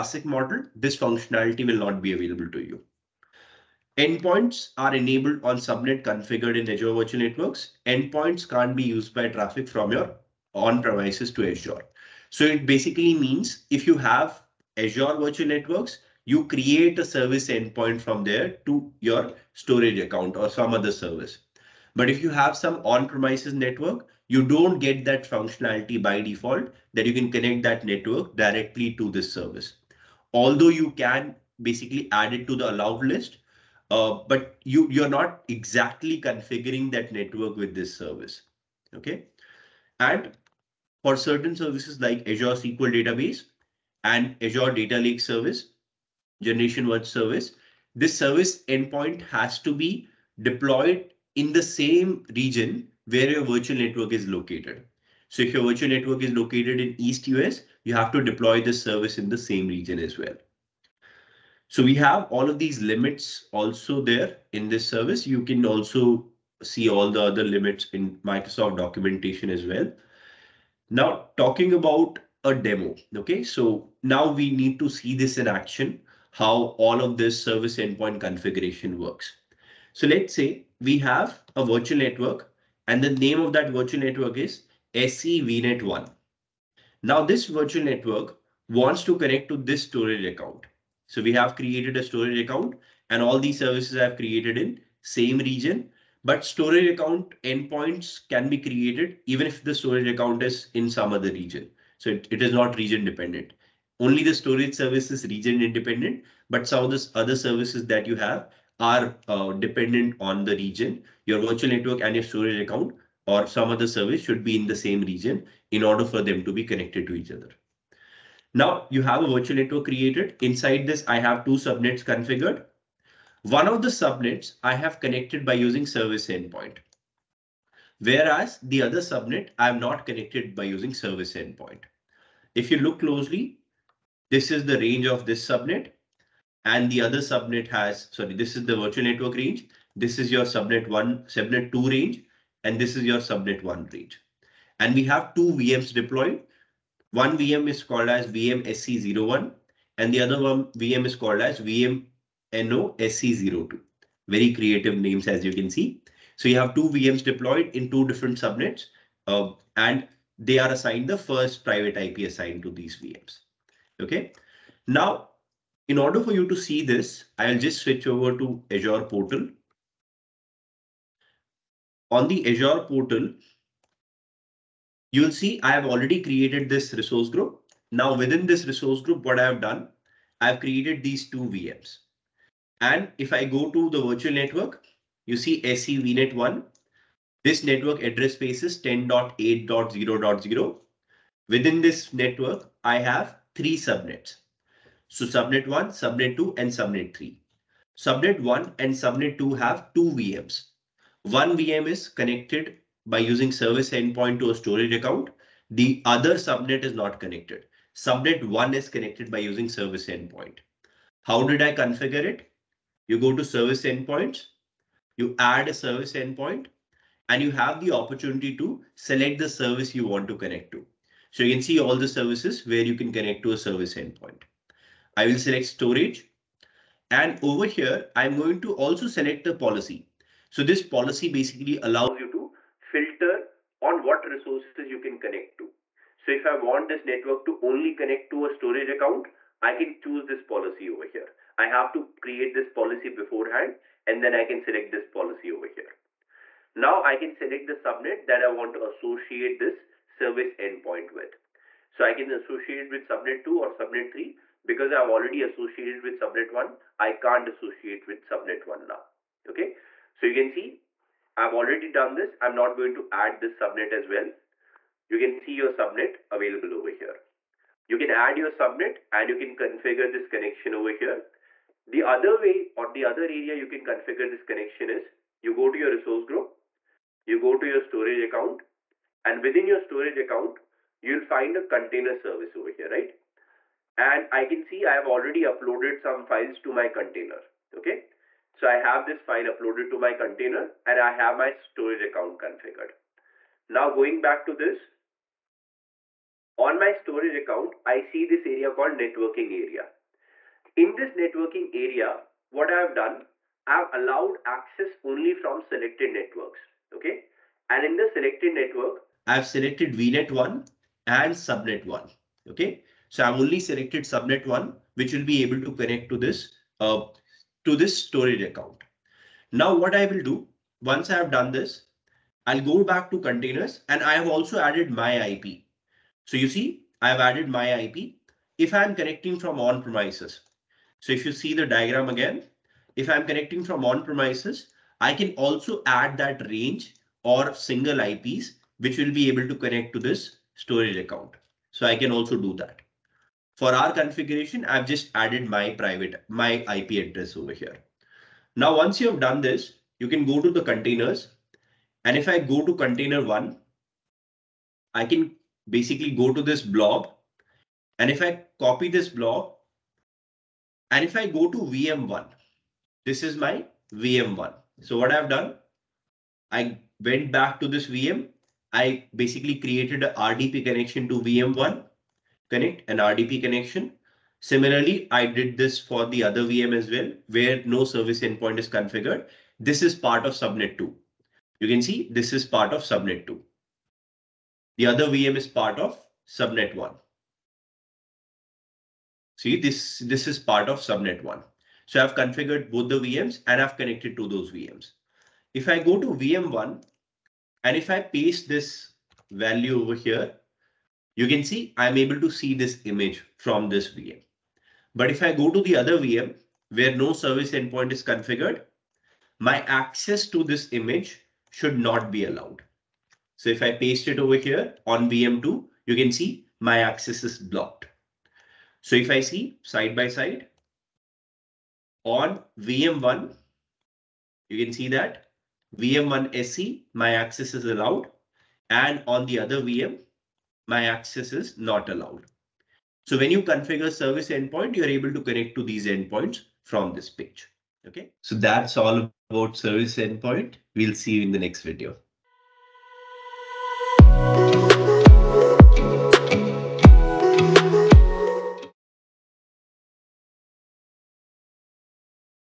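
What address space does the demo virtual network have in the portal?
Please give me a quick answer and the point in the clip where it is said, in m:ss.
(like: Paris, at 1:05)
10.8.0.0, at 3:08.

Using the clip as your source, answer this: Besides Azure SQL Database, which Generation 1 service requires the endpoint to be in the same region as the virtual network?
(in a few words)
Azure Data Lake Service.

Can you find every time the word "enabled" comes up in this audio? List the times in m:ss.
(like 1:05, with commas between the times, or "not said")
0:04.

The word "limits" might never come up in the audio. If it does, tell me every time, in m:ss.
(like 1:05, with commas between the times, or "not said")
1:02, 1:07.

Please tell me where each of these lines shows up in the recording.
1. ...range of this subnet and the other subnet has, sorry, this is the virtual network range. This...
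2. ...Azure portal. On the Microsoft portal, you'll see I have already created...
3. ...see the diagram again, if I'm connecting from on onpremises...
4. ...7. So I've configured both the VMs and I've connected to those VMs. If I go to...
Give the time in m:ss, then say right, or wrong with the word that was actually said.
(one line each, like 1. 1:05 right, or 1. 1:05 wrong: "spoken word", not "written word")
1. 2:14 right
2. 2:48 wrong: "Azure", not "Microsoft"
3. 5:31 wrong: "premises", not "onpremises"
4. 6:31 wrong: "1", not "7".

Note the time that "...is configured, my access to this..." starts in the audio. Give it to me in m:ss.
6:47.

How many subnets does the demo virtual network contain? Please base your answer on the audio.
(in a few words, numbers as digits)
3.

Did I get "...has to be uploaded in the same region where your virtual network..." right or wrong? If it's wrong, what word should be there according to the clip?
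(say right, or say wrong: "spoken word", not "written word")
wrong: "deployed", not "uploaded".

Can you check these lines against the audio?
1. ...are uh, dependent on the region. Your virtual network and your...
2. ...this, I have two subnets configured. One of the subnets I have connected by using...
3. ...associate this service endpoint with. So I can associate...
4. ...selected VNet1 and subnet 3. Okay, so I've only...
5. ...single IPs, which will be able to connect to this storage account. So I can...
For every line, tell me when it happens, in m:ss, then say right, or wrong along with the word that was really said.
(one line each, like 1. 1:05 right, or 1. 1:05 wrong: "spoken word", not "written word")
1. 1:48 right
2. 2:00 right
3. 4:08 right
4. 5:09 wrong: "1", not "3"
5. 5:37 right.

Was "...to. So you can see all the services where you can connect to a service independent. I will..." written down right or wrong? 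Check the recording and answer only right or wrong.
wrong.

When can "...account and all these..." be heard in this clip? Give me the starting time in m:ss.
1:32.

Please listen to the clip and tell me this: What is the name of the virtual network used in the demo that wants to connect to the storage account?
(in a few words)
scvnet one.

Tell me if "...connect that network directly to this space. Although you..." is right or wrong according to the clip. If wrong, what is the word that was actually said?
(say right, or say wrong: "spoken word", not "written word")
wrong: "service", not "space".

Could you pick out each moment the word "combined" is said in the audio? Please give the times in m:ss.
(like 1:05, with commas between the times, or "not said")
not said.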